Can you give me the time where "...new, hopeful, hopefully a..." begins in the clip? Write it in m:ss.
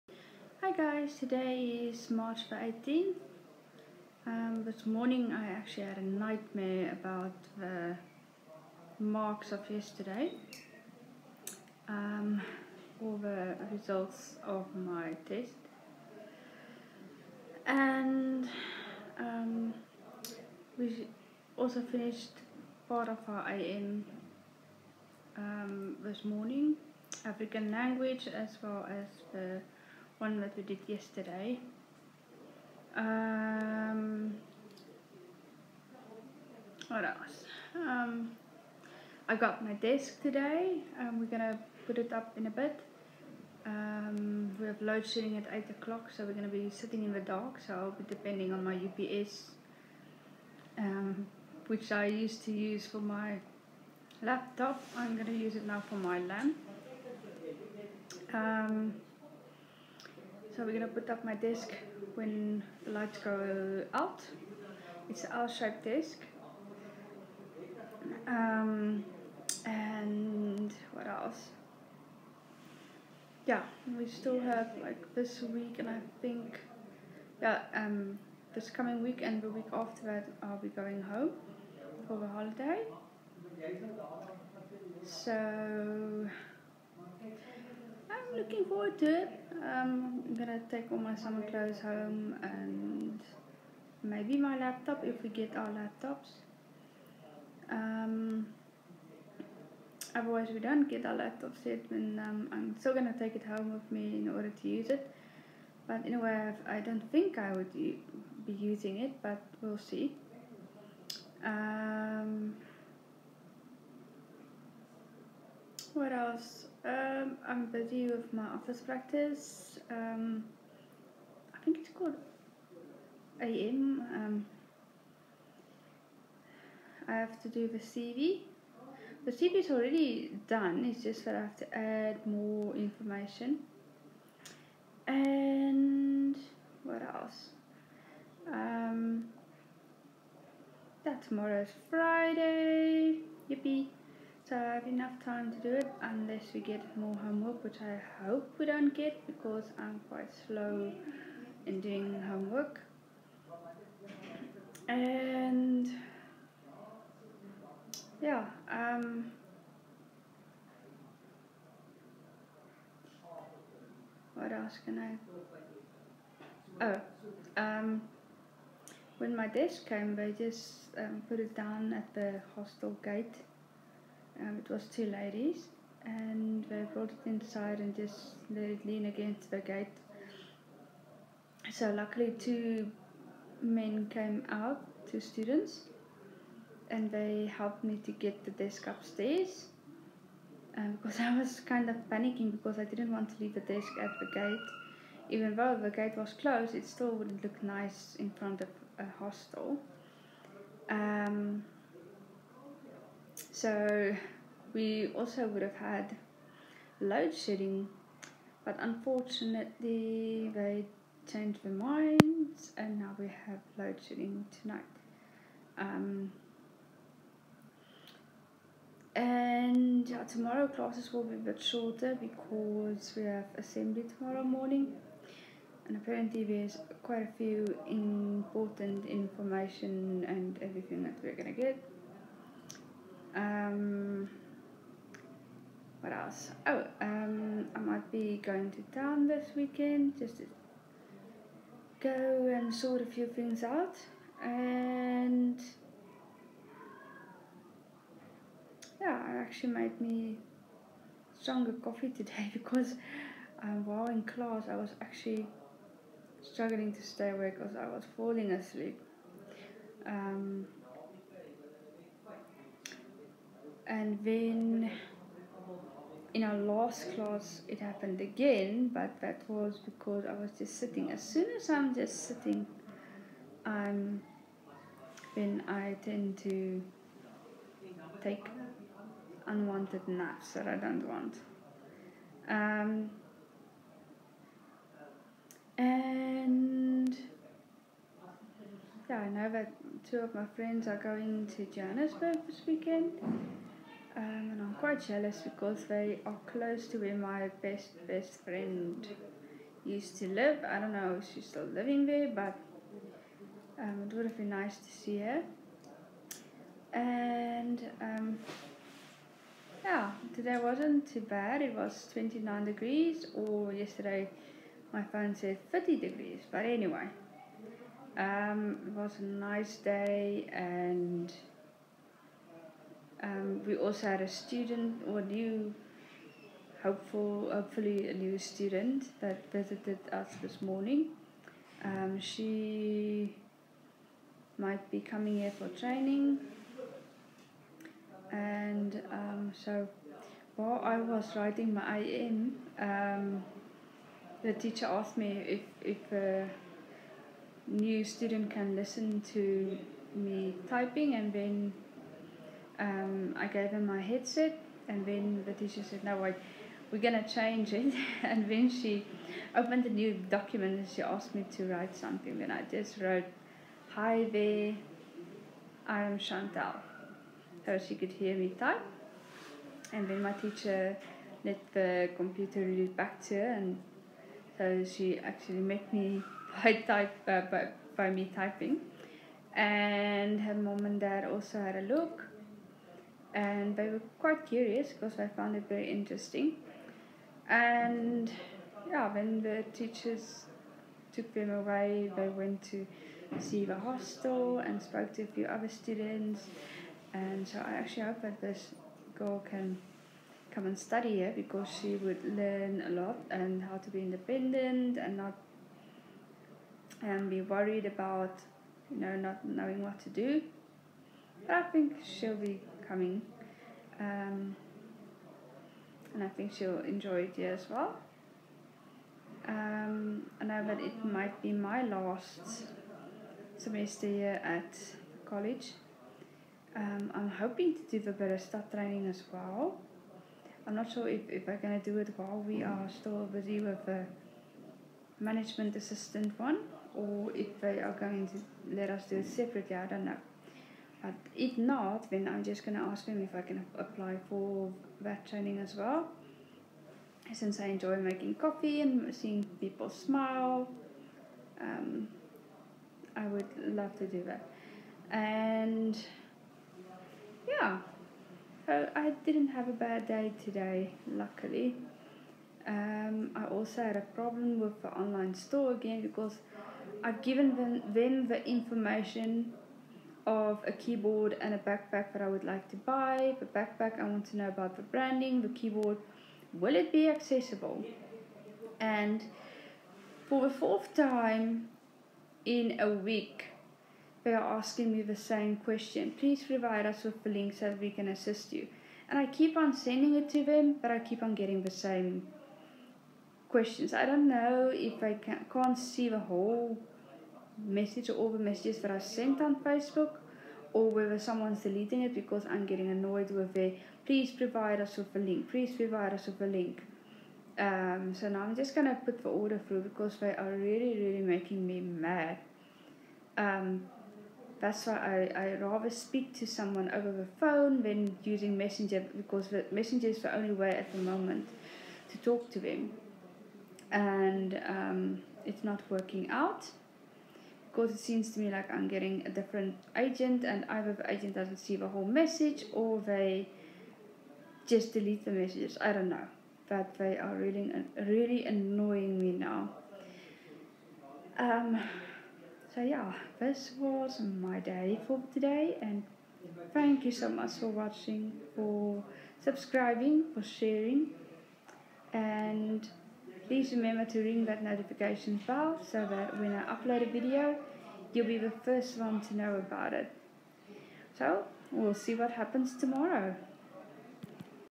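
5:25.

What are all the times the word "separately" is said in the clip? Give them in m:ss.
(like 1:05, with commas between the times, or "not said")
7:19.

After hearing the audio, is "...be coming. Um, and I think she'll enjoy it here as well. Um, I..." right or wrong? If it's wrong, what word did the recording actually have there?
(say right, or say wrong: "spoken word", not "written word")
right.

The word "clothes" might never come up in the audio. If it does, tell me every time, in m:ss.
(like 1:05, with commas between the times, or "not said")
1:31.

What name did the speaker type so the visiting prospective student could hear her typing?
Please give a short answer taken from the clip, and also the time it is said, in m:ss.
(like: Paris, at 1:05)
Chantal, at 6:06.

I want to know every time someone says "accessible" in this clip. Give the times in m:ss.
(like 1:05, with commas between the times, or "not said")
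7:57.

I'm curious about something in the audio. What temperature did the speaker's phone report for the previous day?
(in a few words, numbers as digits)
30 degrees.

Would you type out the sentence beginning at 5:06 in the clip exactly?
And um, yeah, today wasn't too bad.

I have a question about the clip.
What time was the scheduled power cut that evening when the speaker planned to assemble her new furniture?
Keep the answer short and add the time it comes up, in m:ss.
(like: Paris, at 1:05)
8 o'clock, at 0:45.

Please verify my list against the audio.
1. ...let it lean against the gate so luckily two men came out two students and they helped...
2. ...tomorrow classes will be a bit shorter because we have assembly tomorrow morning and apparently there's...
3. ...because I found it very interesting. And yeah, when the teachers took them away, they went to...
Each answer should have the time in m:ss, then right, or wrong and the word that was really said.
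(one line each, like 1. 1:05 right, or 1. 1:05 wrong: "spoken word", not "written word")
1. 2:58 right
2. 3:40 right
3. 6:24 right.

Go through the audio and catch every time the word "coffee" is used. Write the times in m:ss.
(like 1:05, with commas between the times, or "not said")
4:11, 7:28.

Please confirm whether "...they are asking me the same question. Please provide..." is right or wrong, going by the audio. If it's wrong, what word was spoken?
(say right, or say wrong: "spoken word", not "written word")
right.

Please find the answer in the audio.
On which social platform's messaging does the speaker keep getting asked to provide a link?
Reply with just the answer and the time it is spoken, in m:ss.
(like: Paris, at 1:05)
Facebook, at 8:19.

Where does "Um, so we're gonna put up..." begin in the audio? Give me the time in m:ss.
0:58.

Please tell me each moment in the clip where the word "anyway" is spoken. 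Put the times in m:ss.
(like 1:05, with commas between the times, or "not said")
1:46, 5:16.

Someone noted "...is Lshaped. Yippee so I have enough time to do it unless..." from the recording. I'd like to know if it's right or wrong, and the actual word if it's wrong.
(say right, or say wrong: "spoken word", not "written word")
wrong: "Friday", not "Lshaped".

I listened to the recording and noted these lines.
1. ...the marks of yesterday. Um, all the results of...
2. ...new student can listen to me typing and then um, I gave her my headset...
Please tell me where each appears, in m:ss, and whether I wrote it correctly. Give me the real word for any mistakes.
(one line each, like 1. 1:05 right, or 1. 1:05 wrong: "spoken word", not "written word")
1. 0:07 right
2. 5:47 right.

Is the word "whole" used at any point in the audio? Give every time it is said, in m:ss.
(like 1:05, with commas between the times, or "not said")
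8:16, 8:51.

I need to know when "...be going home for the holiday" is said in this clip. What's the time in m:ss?
1:20.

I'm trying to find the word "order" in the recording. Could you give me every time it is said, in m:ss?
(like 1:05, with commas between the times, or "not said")
1:44, 8:29.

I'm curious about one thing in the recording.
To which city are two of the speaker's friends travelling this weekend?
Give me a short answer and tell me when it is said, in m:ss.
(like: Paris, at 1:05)
Johannesburg, at 4:51.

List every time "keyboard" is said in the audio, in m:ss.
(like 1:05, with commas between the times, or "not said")
7:50, 7:55.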